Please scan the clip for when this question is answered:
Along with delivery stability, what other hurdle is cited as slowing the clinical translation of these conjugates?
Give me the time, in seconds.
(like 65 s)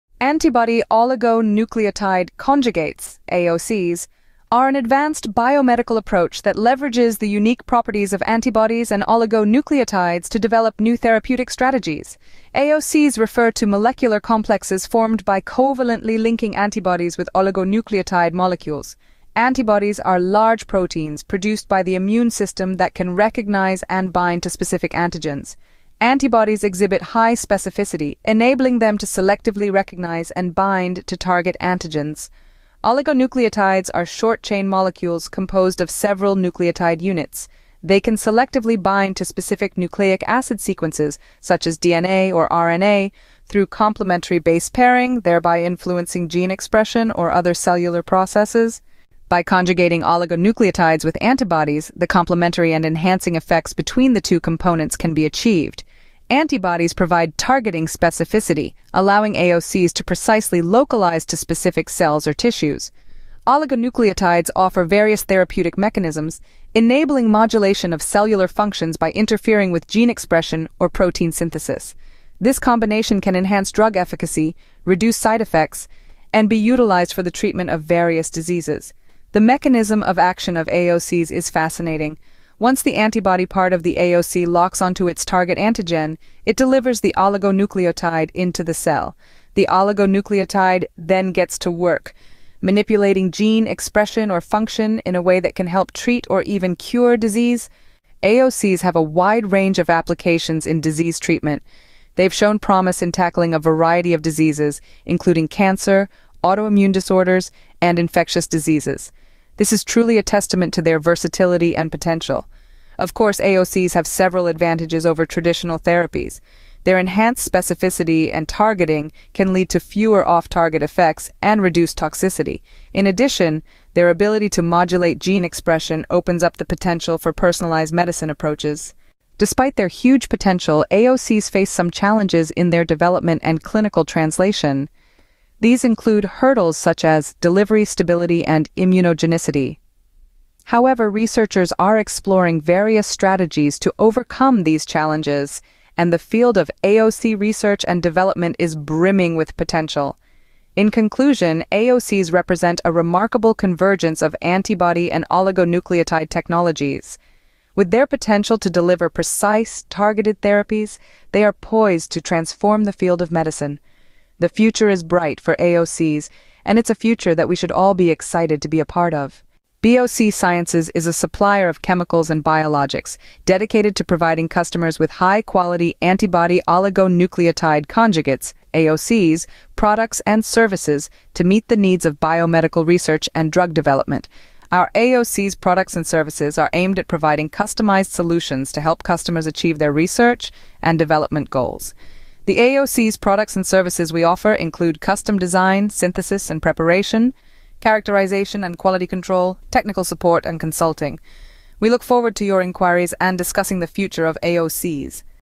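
138 s.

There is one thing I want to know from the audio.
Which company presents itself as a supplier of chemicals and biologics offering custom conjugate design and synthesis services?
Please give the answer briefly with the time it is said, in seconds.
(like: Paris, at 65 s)
BOC Sciences, at 169 s.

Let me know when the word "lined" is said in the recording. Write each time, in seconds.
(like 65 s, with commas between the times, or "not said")
not said.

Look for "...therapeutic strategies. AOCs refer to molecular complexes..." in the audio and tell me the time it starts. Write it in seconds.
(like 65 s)
10 s.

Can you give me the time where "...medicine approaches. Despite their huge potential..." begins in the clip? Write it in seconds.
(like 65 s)
127 s.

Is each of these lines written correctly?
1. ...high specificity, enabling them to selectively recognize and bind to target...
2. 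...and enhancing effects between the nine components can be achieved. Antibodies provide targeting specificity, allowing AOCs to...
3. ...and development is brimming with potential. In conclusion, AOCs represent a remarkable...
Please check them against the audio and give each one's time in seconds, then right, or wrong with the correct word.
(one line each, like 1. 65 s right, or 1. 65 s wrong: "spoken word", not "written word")
1. 27 s right
2. 52 s wrong: "two", not "nine"
3. 147 s right.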